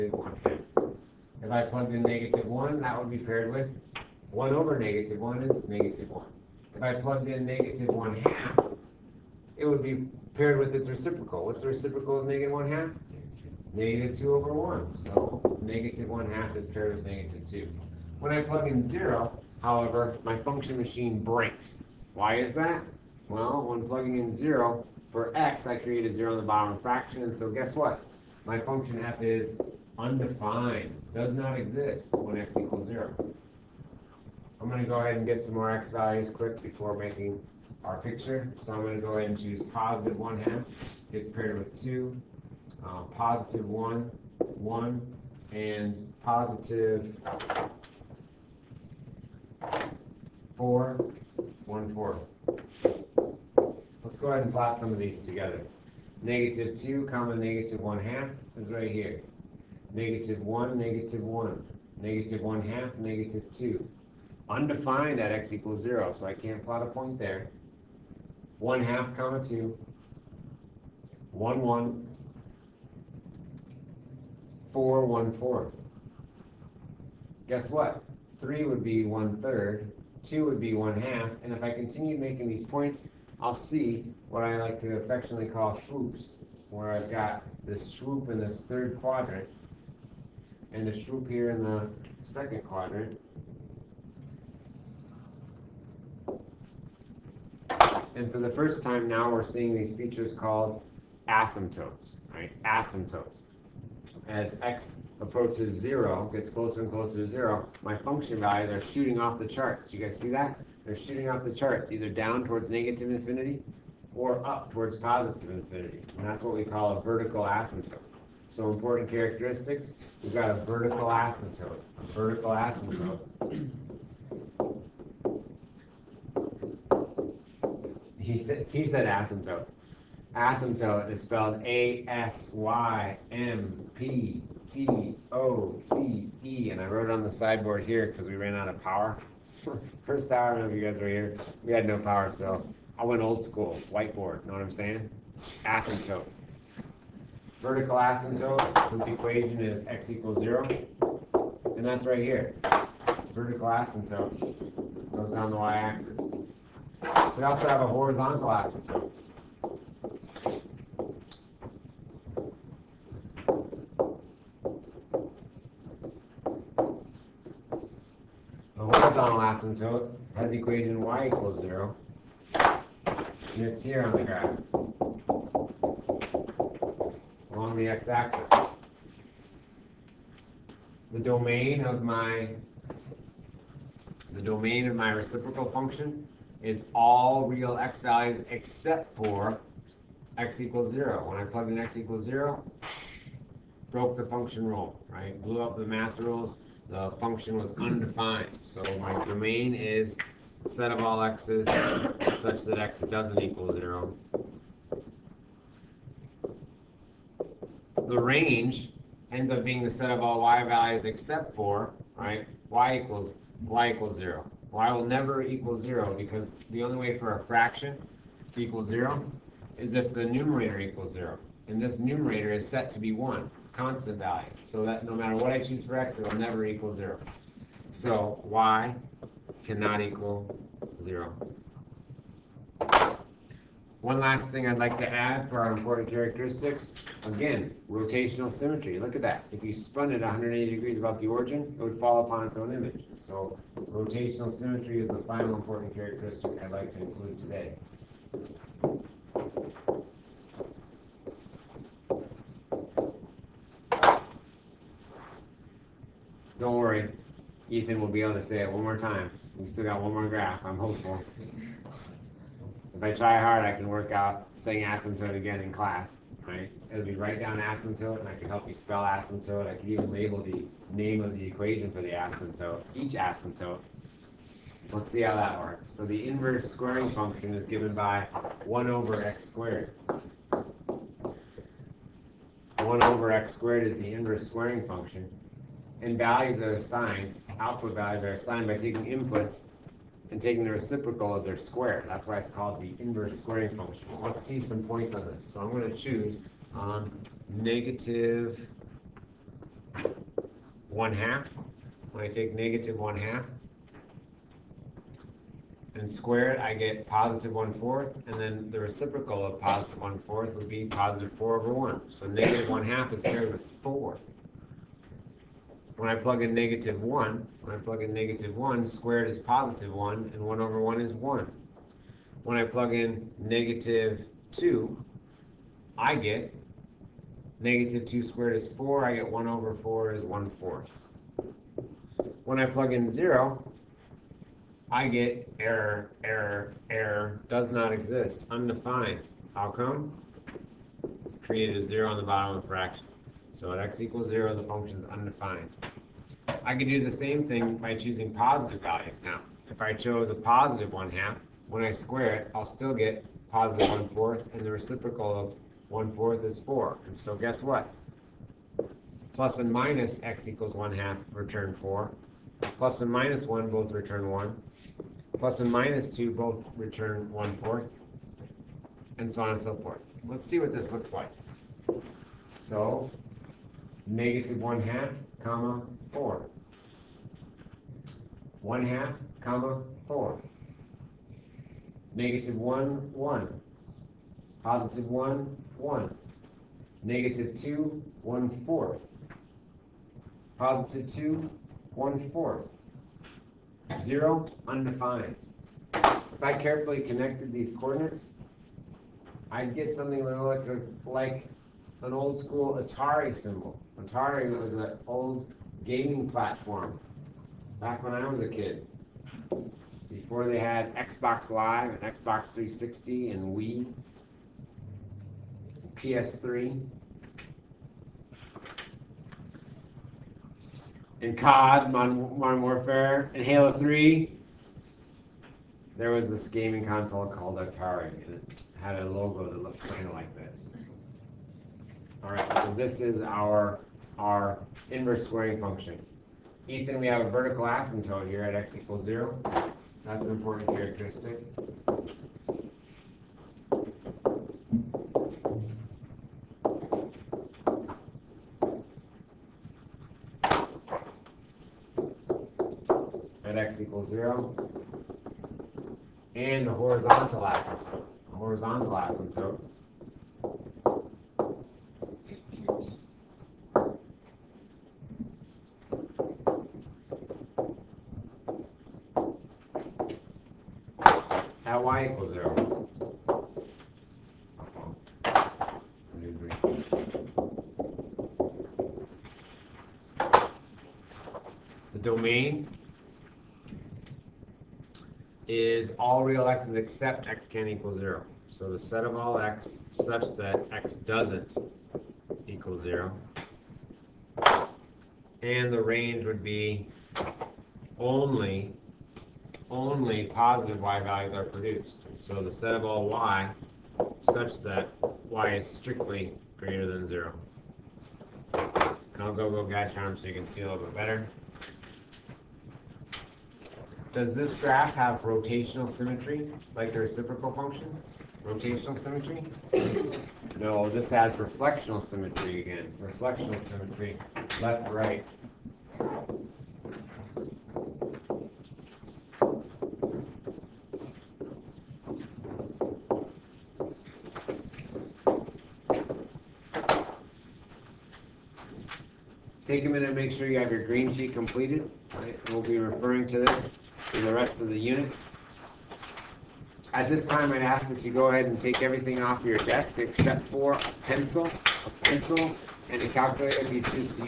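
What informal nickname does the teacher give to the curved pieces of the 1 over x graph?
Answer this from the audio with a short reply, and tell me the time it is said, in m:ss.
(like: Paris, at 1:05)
swoops, at 1:25.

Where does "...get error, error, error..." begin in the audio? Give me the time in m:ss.
5:35.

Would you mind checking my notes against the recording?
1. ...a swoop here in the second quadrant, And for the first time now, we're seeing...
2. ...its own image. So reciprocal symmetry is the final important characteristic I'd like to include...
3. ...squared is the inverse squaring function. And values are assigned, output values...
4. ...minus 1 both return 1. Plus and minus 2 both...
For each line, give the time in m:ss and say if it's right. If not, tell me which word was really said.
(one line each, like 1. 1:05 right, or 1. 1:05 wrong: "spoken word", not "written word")
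1. 1:30 right
2. 4:02 wrong: "rotational", not "reciprocal"
3. 4:43 right
4. 6:03 right.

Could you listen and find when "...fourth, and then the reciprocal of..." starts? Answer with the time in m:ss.
5:07.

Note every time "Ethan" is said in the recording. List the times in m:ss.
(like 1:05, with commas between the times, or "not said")
4:17, 7:16.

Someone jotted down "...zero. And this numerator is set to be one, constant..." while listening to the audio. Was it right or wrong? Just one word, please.
right.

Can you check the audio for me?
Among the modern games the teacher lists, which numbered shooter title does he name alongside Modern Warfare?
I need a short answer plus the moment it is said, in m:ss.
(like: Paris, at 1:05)
Halo 3, at 7:03.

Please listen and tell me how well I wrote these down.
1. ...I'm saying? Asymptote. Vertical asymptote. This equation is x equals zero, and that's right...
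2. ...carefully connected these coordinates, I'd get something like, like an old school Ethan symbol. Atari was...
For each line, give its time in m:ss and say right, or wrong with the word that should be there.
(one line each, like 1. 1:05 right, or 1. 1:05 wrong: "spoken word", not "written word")
1. 2:24 right
2. 6:36 wrong: "Atari", not "Ethan".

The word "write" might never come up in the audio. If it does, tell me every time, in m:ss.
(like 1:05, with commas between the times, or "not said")
4:27.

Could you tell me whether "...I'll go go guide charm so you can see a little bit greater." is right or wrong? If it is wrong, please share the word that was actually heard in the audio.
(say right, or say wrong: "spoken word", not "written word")
wrong: "better", not "greater".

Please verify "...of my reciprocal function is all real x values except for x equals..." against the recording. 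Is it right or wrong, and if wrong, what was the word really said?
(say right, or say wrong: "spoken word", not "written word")
right.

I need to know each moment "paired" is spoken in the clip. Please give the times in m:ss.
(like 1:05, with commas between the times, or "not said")
0:03, 0:10, 0:16, 0:41, 5:13.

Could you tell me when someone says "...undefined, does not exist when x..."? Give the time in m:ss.
0:29.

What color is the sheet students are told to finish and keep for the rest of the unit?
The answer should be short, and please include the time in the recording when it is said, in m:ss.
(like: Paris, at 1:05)
green, at 9:00.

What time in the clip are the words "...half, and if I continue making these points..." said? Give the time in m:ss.
1:20.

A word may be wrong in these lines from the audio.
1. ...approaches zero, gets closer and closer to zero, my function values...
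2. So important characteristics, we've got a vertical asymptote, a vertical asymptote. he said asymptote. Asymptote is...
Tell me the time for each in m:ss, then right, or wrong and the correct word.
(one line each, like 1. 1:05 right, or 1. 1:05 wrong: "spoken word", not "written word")
1. 1:45 right
2. 1:58 right.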